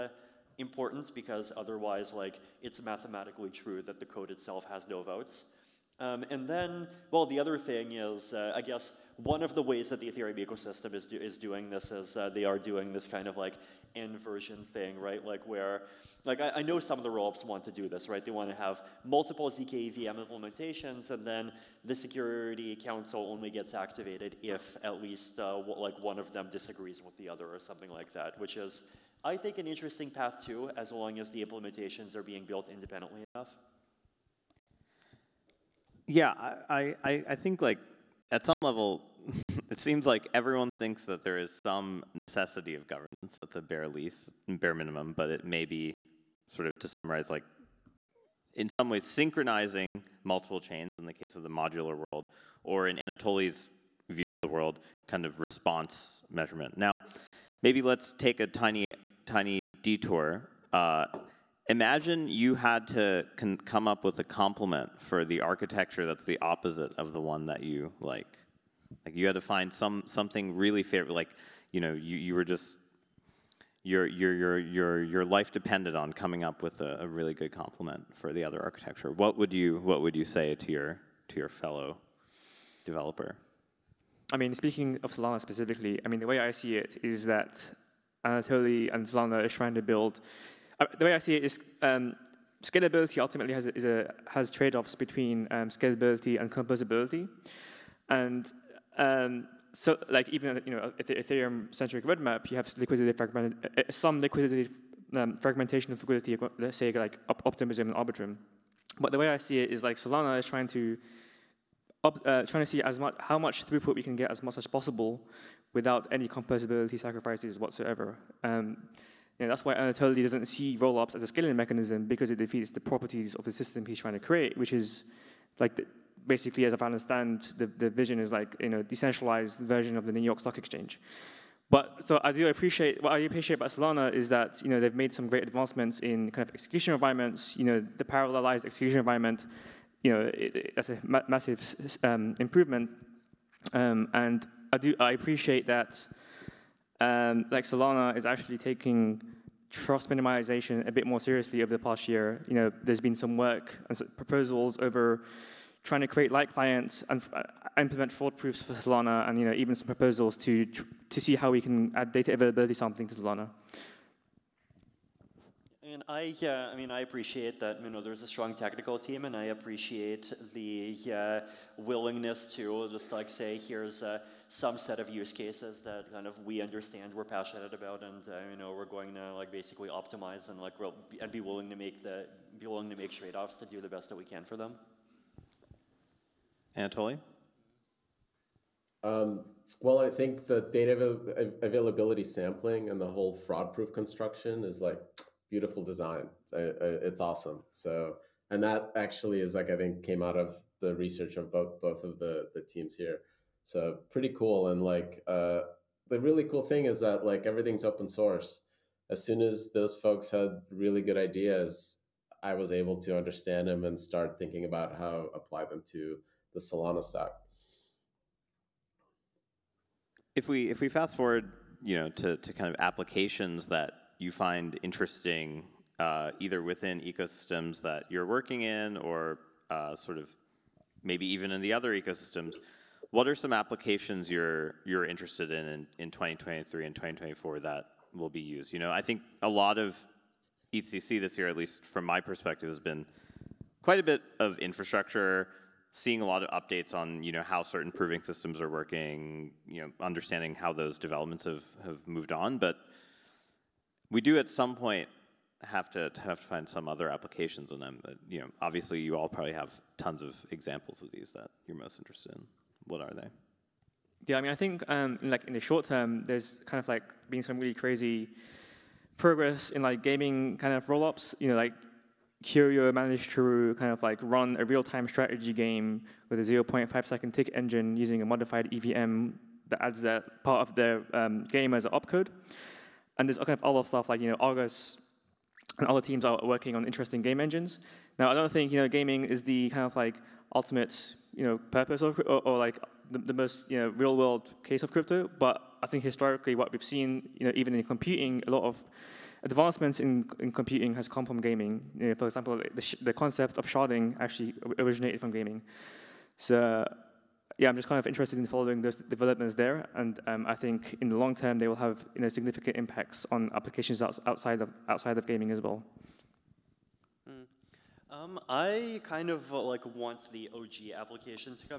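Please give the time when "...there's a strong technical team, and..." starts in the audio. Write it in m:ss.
2:48.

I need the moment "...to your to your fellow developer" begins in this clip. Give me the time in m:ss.
1:20.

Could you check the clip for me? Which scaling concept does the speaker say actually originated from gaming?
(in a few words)
sharding.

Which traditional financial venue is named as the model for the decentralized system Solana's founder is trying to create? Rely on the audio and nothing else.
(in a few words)
New York Stock Exchange.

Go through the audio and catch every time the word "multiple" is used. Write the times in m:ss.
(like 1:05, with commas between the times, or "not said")
0:19, 0:50.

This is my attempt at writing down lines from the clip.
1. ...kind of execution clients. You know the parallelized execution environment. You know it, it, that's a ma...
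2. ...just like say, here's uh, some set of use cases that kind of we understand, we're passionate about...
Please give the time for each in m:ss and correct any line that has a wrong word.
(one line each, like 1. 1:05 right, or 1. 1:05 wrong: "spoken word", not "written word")
1. 2:16 wrong: "environments", not "clients"
2. 2:52 right.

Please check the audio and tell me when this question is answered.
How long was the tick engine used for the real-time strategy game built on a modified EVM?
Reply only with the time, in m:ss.
4:36.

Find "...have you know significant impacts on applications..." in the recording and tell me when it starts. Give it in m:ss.
5:11.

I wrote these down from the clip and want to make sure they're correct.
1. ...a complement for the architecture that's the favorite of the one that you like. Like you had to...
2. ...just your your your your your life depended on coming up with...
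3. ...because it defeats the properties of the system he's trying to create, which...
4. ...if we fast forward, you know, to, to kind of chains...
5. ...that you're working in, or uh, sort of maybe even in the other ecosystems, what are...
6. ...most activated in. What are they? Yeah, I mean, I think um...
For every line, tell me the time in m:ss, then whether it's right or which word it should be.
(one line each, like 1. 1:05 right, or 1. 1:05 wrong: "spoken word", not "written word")
1. 1:04 wrong: "opposite", not "favorite"
2. 1:12 right
3. 2:02 right
4. 3:40 wrong: "applications", not "chains"
5. 3:47 right
6. 4:21 wrong: "interested", not "activated".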